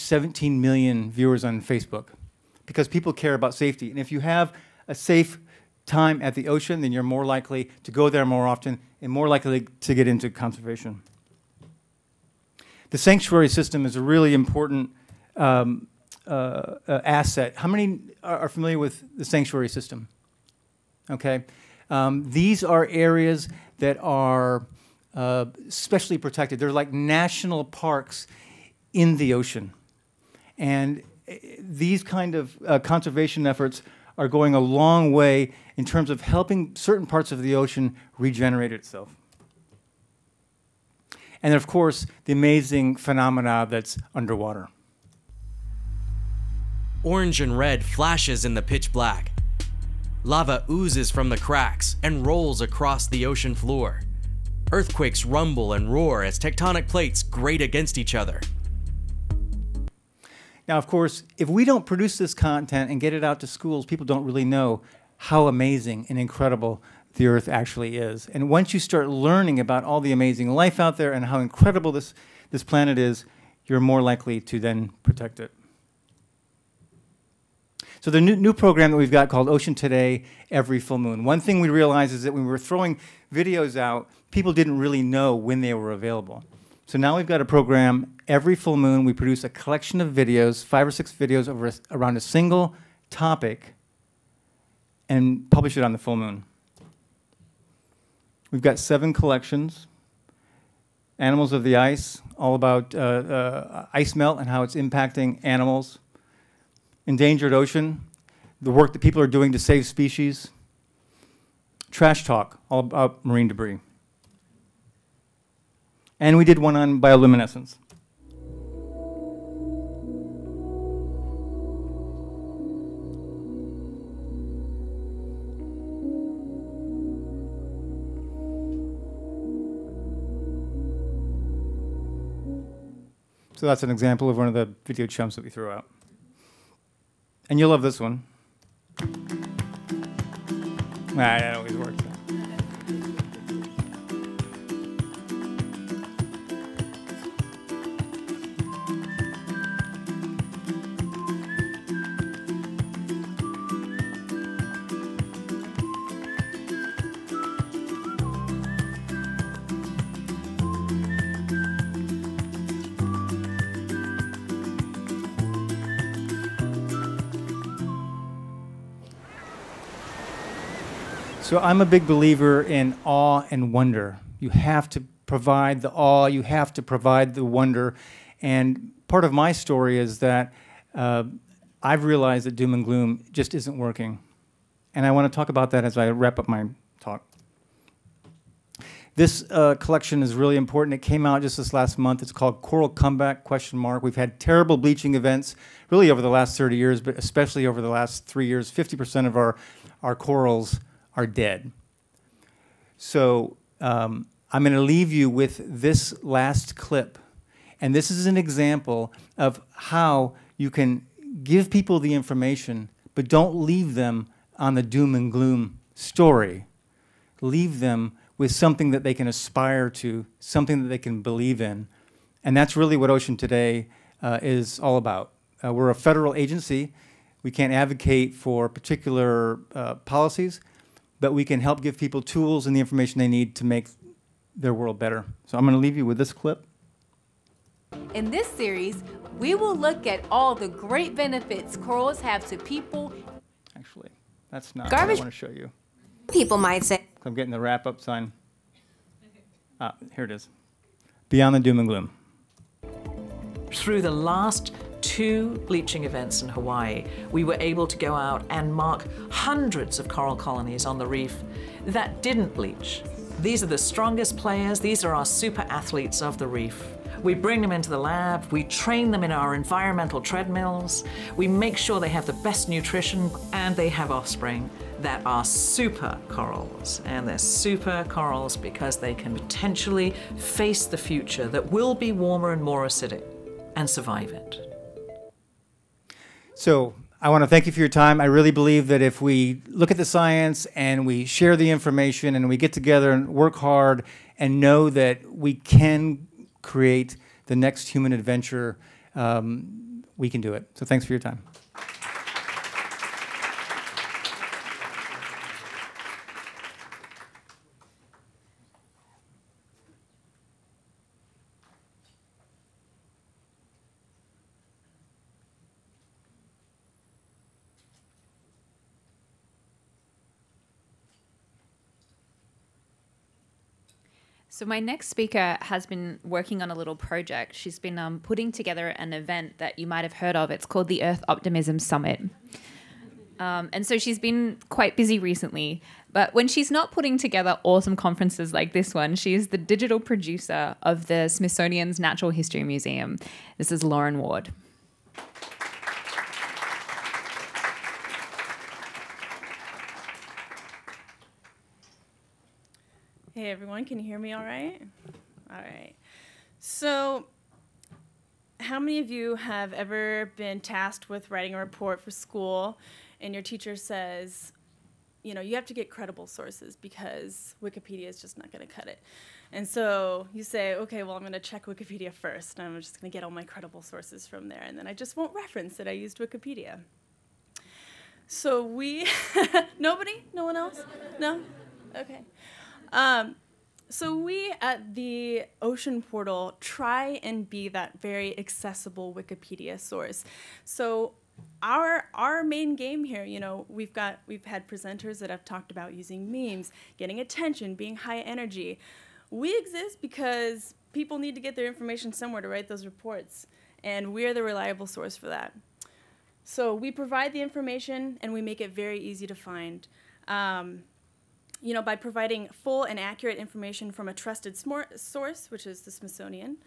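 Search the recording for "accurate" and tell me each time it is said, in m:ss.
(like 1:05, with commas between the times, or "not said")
6:52.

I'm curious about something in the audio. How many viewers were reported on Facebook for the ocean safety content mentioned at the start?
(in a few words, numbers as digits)
17 million.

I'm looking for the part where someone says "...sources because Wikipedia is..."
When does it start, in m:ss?
6:06.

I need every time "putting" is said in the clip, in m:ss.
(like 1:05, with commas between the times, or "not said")
5:28, 5:36.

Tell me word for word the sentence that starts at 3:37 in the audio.
Leave them with something that they can aspire to, something that they can believe in.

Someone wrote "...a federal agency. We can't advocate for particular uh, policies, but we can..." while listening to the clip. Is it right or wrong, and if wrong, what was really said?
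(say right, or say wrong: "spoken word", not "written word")
right.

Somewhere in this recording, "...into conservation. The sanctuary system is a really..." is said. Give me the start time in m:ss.
0:10.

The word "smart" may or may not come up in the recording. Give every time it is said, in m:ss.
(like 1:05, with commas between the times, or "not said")
not said.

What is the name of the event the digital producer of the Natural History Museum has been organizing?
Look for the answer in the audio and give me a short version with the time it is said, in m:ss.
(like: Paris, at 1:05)
Earth Optimism Summit, at 5:31.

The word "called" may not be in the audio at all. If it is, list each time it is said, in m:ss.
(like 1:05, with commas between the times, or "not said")
1:19, 3:12, 5:30.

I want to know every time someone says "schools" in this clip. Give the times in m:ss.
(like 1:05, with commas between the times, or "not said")
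1:03, 6:02.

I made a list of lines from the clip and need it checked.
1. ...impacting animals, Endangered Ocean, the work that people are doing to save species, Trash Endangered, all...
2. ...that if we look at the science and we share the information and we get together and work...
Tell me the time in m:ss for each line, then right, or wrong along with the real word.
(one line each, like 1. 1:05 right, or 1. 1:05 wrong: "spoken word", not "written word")
1. 1:44 wrong: "Talk", not "Endangered"
2. 4:48 right.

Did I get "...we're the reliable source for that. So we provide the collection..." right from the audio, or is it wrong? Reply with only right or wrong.
wrong.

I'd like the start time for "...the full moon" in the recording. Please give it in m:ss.
1:35.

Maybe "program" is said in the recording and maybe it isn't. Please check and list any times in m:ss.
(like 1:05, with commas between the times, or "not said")
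1:18, 1:27.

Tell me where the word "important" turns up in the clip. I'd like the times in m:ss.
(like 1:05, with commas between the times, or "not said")
0:14, 3:10.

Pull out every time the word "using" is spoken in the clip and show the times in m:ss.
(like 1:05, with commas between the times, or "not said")
6:35.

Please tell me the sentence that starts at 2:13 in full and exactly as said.
So that's an example of one of the video chumps that we threw out.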